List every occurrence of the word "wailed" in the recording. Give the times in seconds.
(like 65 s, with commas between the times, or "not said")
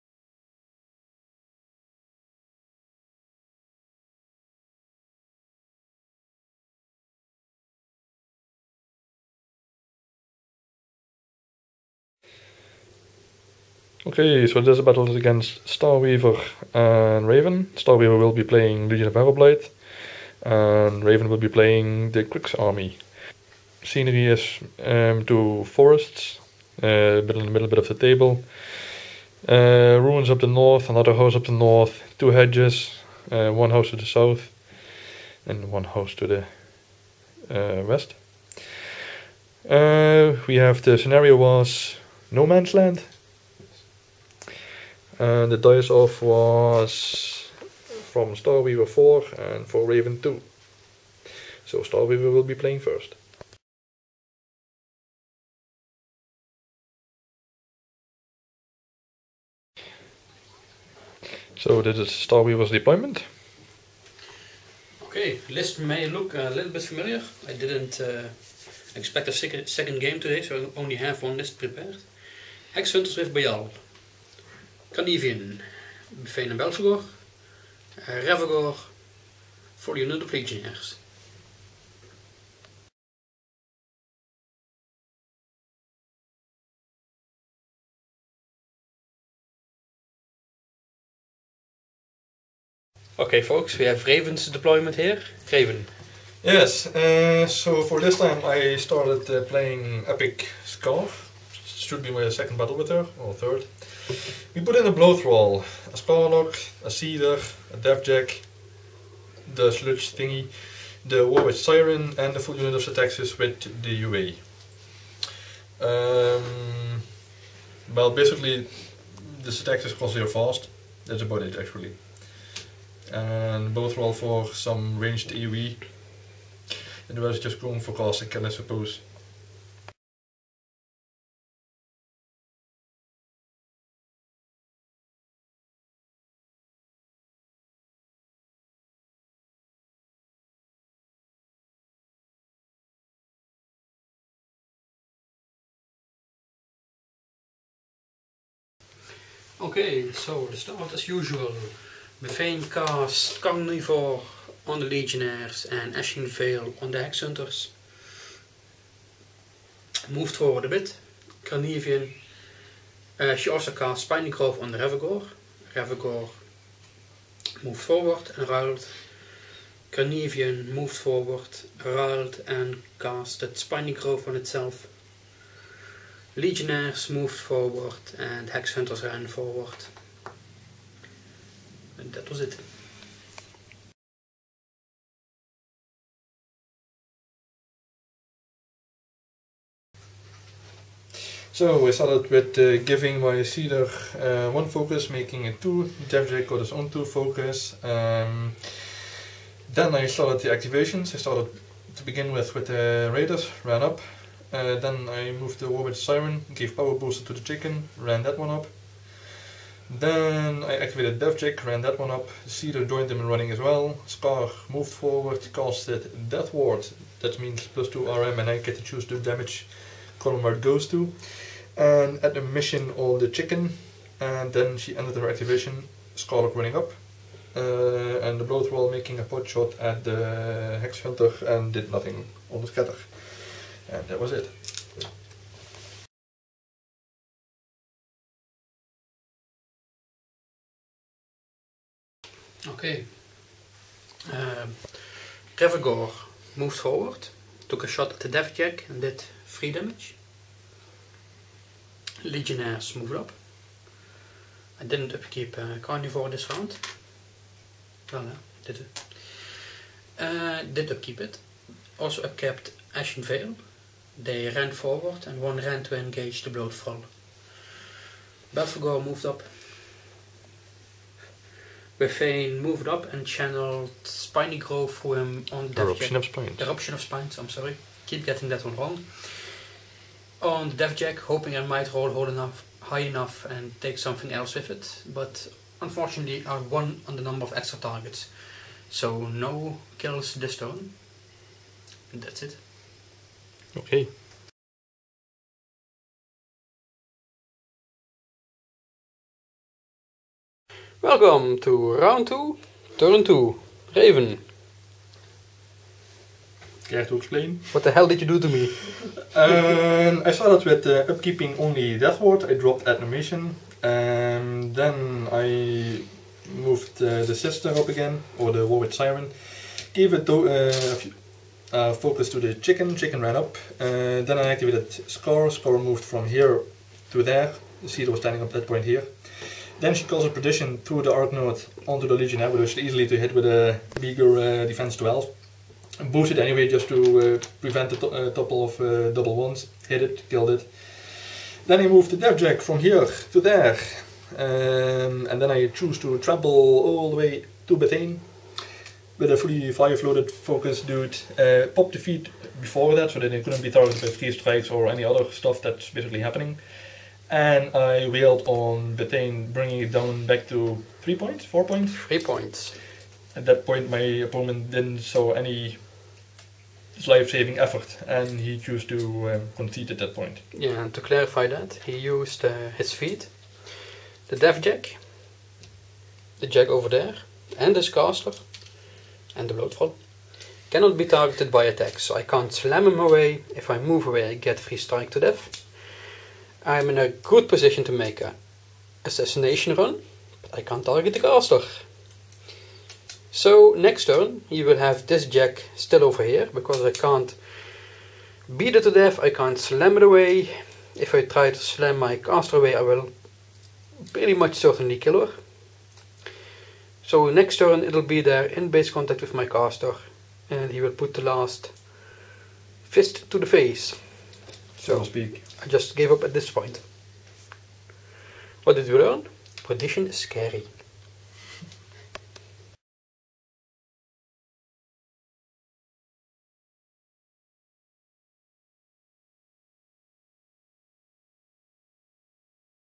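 358 s.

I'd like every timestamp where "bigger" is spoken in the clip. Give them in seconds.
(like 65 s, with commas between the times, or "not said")
333 s.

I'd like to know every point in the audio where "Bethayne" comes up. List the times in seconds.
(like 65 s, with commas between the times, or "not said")
152 s, 271 s, 347 s, 358 s.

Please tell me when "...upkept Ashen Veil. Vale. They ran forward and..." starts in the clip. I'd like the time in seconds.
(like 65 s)
262 s.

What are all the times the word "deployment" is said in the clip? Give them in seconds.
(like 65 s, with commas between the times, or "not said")
62 s, 94 s.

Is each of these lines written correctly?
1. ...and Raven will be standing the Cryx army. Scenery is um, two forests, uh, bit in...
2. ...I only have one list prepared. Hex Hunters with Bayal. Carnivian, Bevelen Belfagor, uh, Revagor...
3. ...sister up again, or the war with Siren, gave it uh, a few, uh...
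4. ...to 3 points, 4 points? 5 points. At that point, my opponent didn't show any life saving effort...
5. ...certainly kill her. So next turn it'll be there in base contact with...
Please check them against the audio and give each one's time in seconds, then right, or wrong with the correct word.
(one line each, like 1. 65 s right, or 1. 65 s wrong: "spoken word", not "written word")
1. 20 s wrong: "playing", not "standing"
2. 70 s right
3. 317 s right
4. 360 s wrong: "3", not "5"
5. 404 s right.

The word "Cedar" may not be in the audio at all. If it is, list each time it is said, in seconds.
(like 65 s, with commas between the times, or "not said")
193 s.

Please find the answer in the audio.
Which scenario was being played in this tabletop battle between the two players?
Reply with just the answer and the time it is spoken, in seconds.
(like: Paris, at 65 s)
No Man's Land, at 42 s.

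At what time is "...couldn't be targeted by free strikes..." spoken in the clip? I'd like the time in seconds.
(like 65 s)
353 s.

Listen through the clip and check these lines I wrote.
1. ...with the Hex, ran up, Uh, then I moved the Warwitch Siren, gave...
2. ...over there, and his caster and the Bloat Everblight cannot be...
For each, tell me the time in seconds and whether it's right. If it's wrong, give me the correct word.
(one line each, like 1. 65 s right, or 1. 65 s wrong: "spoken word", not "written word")
1. 202 s wrong: "Raiders", not "Hex"
2. 376 s wrong: "Thrall", not "Everblight".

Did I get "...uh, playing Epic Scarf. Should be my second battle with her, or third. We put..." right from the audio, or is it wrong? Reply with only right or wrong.
right.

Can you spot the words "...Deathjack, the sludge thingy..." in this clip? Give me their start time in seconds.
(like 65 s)
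107 s.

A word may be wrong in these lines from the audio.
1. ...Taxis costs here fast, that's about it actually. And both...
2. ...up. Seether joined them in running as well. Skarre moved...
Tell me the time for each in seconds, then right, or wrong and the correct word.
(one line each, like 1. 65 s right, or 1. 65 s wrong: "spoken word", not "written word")
1. 119 s right
2. 212 s right.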